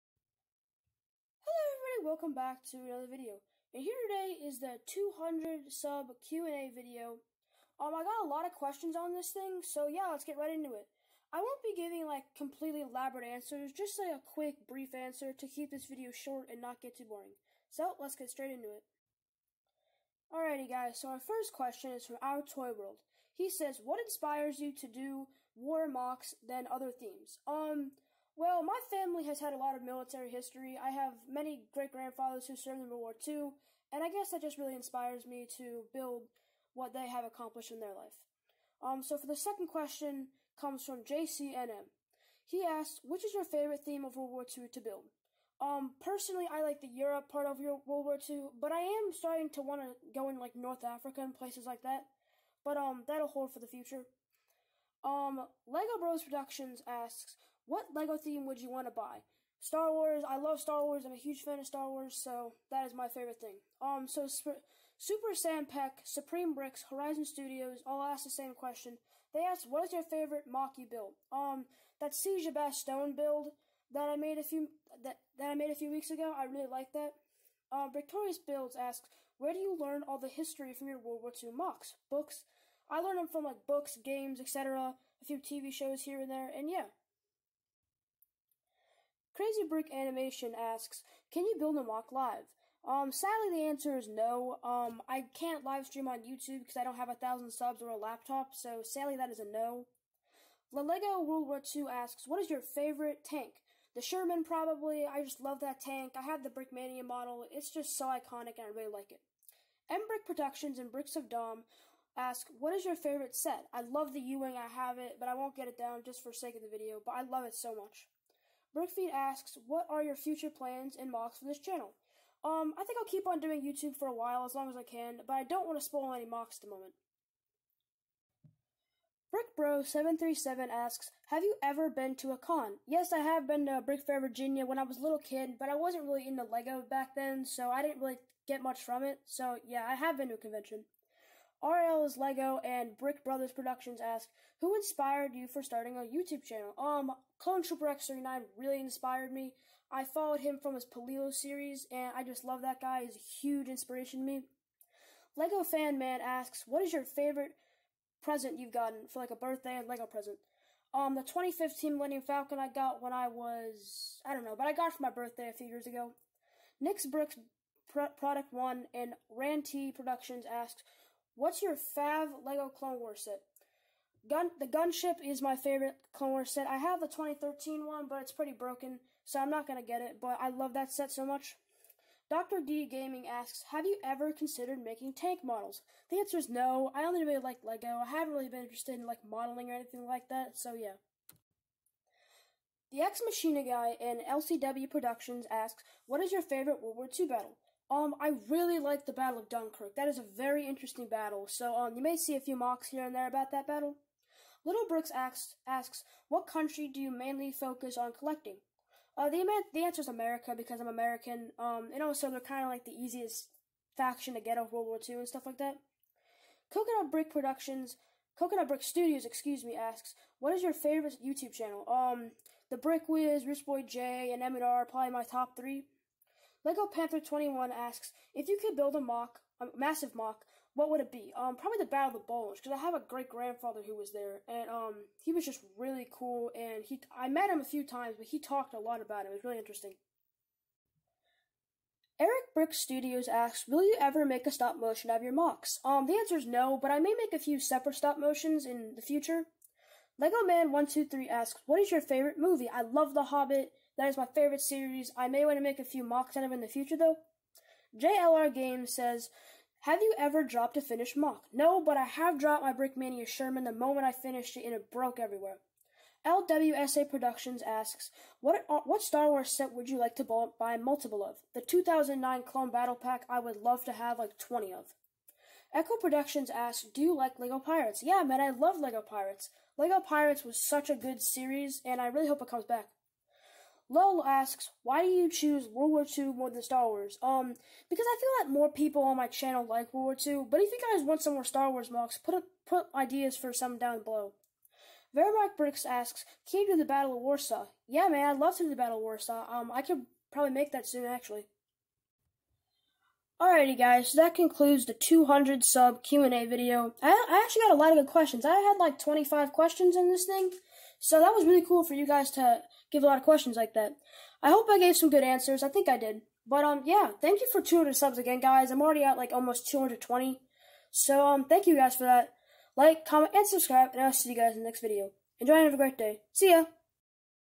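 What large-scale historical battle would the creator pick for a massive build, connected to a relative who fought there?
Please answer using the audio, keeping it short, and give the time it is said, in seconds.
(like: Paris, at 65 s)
Battle of the Bulge, at 231 s.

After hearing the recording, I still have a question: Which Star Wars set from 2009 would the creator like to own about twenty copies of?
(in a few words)
Clone Battle Pack.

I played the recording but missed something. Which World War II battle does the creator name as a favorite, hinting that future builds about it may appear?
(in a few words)
Battle of Dunkirk.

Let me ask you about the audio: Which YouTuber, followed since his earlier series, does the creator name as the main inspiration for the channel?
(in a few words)
Clone Trooper X39.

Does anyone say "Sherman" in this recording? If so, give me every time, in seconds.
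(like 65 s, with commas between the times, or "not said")
104 s, 263 s.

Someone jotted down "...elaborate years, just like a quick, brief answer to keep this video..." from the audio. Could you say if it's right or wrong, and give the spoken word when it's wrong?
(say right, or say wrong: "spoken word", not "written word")
wrong: "answers", not "years".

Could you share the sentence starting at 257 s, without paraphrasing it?
JLR Games says, Have you ever dropped a finished mock?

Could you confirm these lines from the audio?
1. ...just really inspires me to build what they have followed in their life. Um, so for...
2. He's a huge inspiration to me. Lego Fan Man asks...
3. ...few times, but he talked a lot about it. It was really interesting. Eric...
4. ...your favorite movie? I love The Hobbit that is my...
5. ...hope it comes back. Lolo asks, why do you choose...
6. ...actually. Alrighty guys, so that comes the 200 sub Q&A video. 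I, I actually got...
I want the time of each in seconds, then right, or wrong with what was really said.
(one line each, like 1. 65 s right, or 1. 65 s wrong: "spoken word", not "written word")
1. 34 s wrong: "accomplished", not "followed"
2. 153 s right
3. 237 s right
4. 251 s right
5. 282 s right
6. 301 s wrong: "concludes", not "comes".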